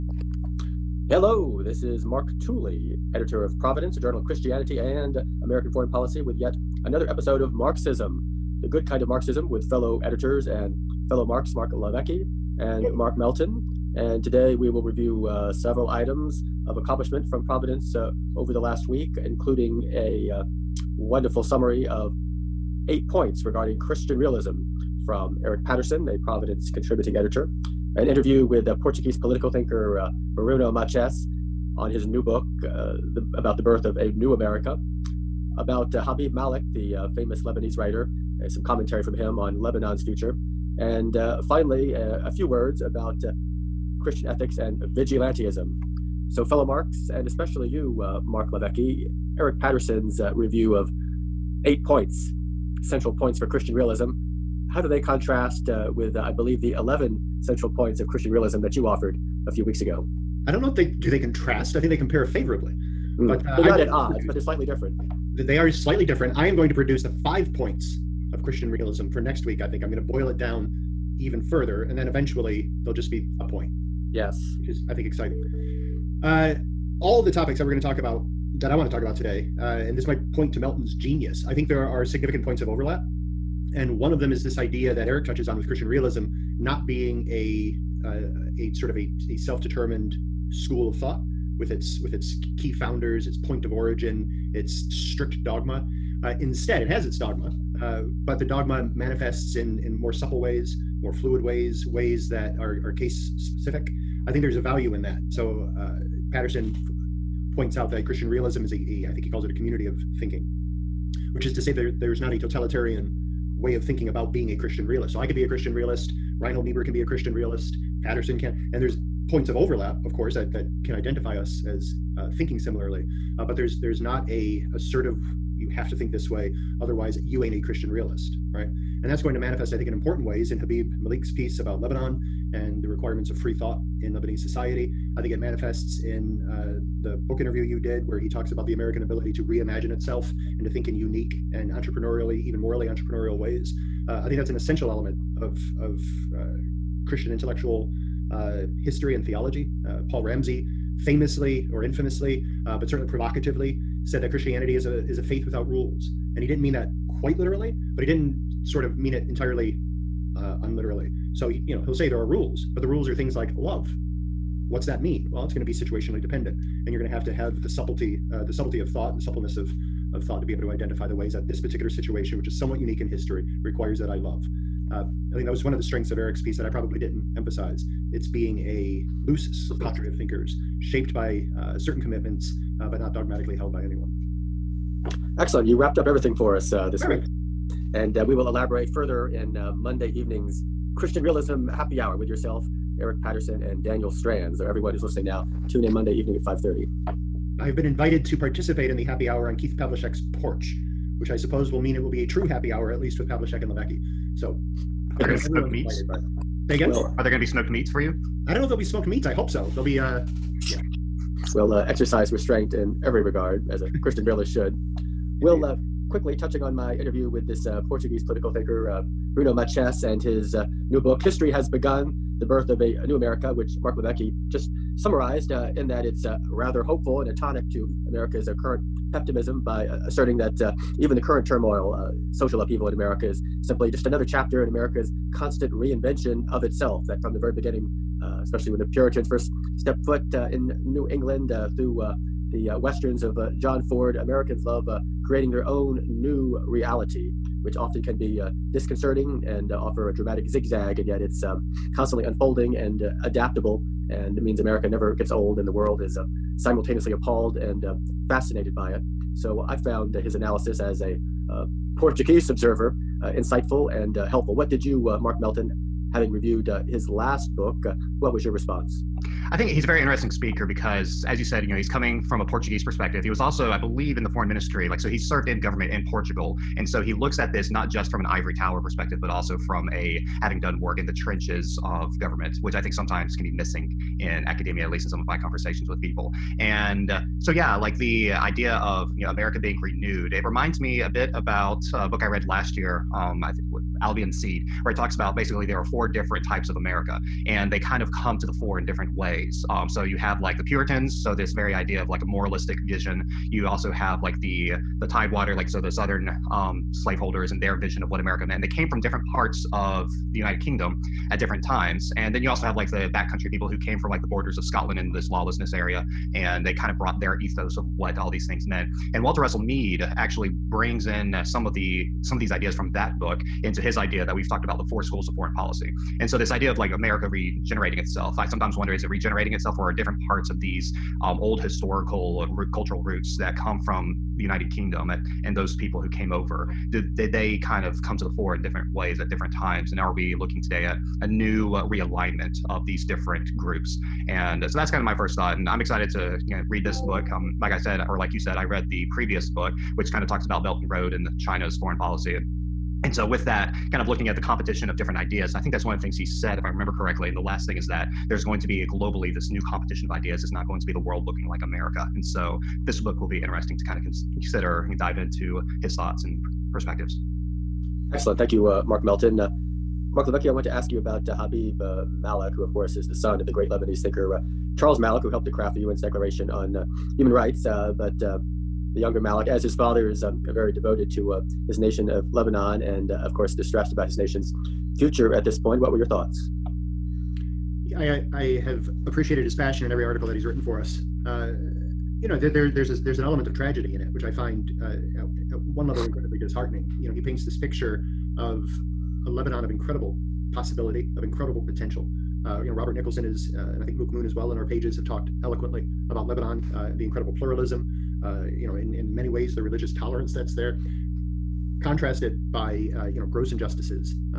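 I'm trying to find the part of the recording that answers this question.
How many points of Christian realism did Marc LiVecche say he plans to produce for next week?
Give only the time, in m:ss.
1:07.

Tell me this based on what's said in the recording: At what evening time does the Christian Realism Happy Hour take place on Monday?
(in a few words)
5:30.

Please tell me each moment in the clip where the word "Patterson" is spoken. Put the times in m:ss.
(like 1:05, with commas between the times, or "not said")
0:25, 0:49, 1:46, 1:58, 3:13.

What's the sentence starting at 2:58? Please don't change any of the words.
It's being a loose cadre of thinkers shaped by uh, certain commitments, uh, but not dogmatically held by anyone.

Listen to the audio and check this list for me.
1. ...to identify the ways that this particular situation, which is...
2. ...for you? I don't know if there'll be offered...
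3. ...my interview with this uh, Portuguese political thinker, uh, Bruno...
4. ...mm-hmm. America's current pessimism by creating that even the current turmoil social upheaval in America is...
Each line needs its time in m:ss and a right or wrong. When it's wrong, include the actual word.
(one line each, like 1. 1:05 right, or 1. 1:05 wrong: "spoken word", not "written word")
1. 2:50 right
2. 3:27 wrong: "smoked", not "offered"
3. 3:36 right
4. 3:47 wrong: "asserting", not "creating".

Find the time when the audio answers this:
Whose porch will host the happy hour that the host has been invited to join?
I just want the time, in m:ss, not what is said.
3:19.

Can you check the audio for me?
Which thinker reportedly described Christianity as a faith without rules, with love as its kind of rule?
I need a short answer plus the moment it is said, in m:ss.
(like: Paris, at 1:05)
Paul Ramsey, at 2:30.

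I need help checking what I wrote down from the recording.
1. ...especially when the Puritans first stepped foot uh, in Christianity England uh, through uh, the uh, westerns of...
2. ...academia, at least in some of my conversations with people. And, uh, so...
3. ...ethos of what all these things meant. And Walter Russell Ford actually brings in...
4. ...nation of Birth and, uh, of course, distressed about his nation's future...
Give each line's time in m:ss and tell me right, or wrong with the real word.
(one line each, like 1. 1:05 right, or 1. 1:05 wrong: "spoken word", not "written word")
1. 3:58 wrong: "New", not "Christianity"
2. 4:44 right
3. 5:17 wrong: "Mead", not "Ford"
4. 6:21 wrong: "Lebanon", not "Birth".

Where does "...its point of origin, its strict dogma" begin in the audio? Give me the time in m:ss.
1:33.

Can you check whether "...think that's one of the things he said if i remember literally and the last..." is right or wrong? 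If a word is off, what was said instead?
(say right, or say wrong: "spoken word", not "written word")
wrong: "correctly", not "literally".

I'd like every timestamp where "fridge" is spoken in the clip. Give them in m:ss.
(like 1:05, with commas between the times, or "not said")
not said.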